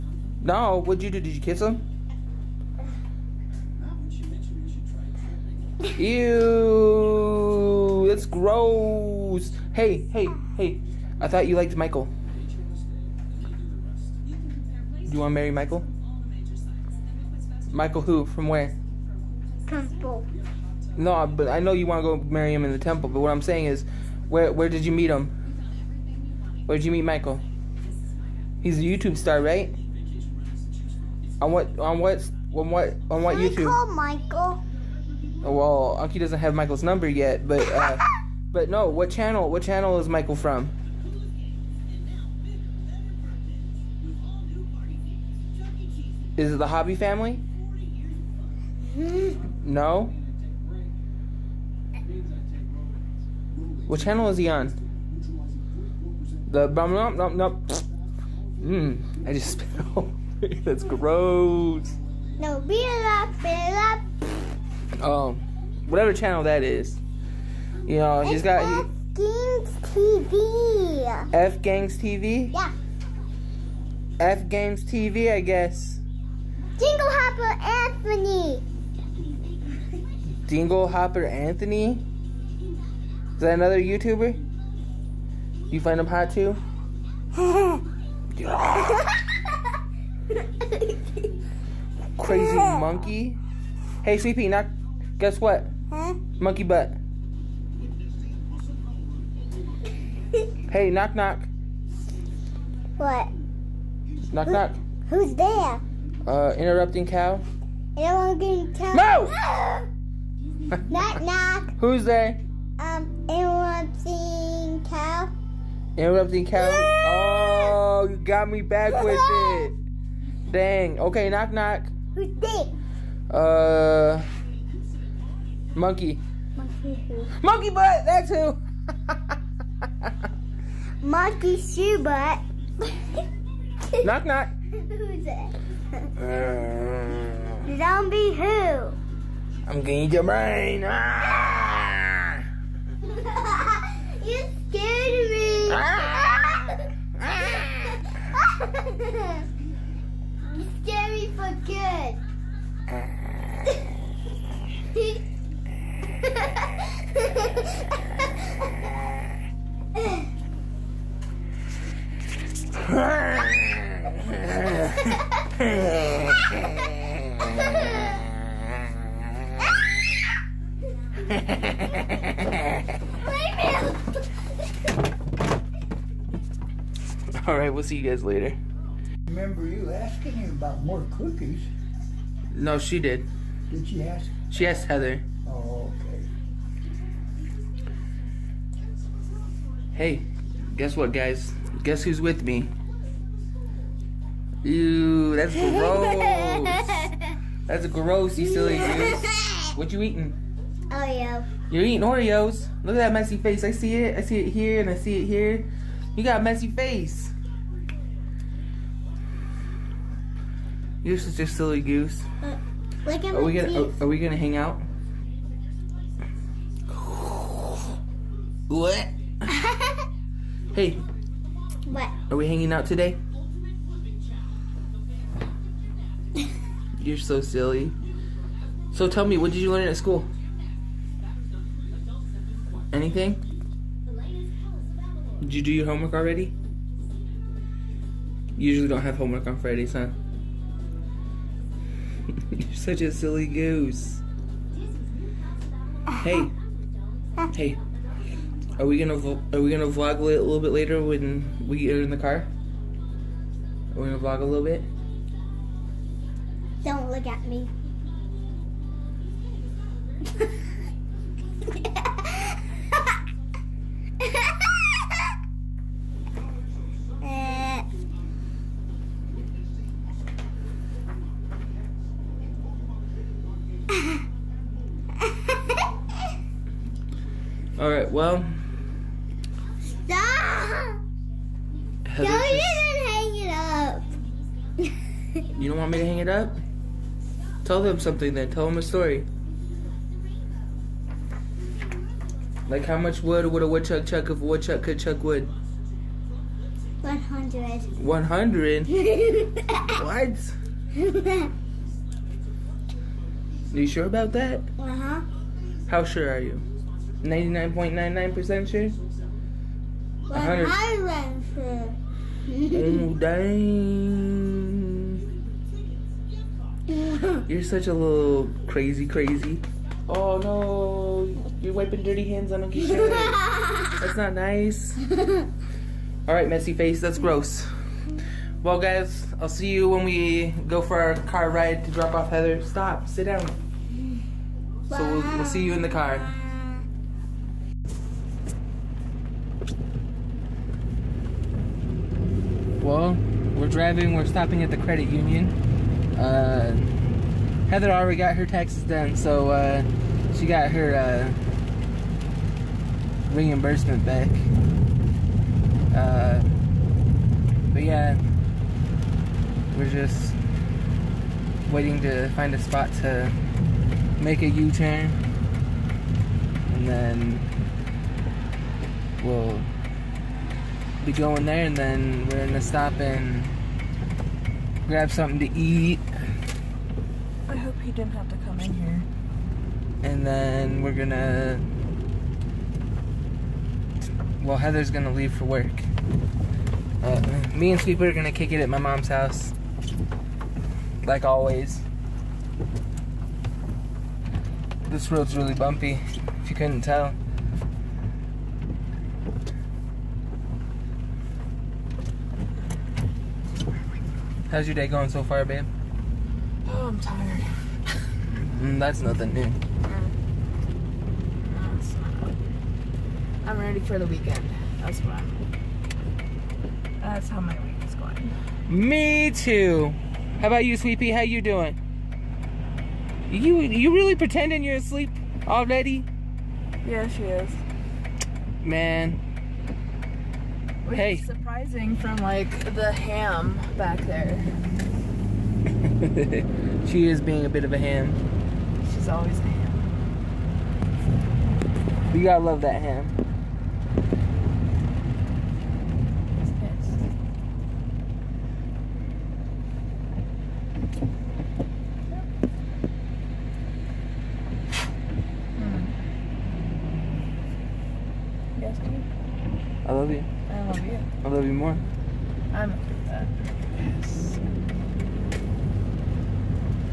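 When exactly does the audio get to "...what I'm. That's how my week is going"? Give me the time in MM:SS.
06:55.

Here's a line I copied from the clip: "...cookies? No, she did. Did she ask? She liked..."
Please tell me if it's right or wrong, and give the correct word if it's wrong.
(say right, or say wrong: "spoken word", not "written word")
wrong: "asked", not "liked".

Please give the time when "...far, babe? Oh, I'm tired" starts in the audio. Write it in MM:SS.
06:45.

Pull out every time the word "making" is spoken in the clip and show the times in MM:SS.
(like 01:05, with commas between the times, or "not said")
not said.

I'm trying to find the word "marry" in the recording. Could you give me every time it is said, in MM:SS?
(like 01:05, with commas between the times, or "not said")
00:15, 00:22.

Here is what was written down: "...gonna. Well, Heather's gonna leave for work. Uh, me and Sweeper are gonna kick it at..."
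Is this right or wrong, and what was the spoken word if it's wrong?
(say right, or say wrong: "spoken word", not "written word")
right.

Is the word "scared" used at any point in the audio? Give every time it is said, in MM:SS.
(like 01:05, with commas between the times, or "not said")
02:24, 02:30.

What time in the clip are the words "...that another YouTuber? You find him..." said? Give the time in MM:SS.
01:23.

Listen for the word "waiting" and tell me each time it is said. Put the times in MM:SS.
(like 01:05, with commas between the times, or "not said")
06:01.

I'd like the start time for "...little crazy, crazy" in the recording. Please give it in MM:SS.
05:17.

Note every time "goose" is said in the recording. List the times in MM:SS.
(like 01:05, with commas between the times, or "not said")
03:18, 03:31, 04:03.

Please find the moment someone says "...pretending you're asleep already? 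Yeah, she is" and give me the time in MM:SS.
07:04.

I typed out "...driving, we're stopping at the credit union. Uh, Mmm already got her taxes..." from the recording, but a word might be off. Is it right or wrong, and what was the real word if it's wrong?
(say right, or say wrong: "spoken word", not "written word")
wrong: "Heather", not "Mmm".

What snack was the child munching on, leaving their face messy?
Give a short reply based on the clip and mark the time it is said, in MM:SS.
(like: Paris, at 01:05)
Oreo, at 03:20.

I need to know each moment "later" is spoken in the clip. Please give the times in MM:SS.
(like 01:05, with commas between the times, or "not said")
02:58, 04:10.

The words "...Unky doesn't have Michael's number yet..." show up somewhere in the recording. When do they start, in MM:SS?
00:36.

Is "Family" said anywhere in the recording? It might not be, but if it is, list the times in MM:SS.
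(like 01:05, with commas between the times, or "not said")
00:46.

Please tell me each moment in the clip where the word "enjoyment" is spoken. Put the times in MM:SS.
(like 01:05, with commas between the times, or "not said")
not said.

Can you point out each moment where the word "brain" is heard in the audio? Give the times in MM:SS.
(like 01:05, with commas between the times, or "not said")
02:20.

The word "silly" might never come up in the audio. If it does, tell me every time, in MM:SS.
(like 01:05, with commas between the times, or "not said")
03:18, 03:31, 03:47, 04:03.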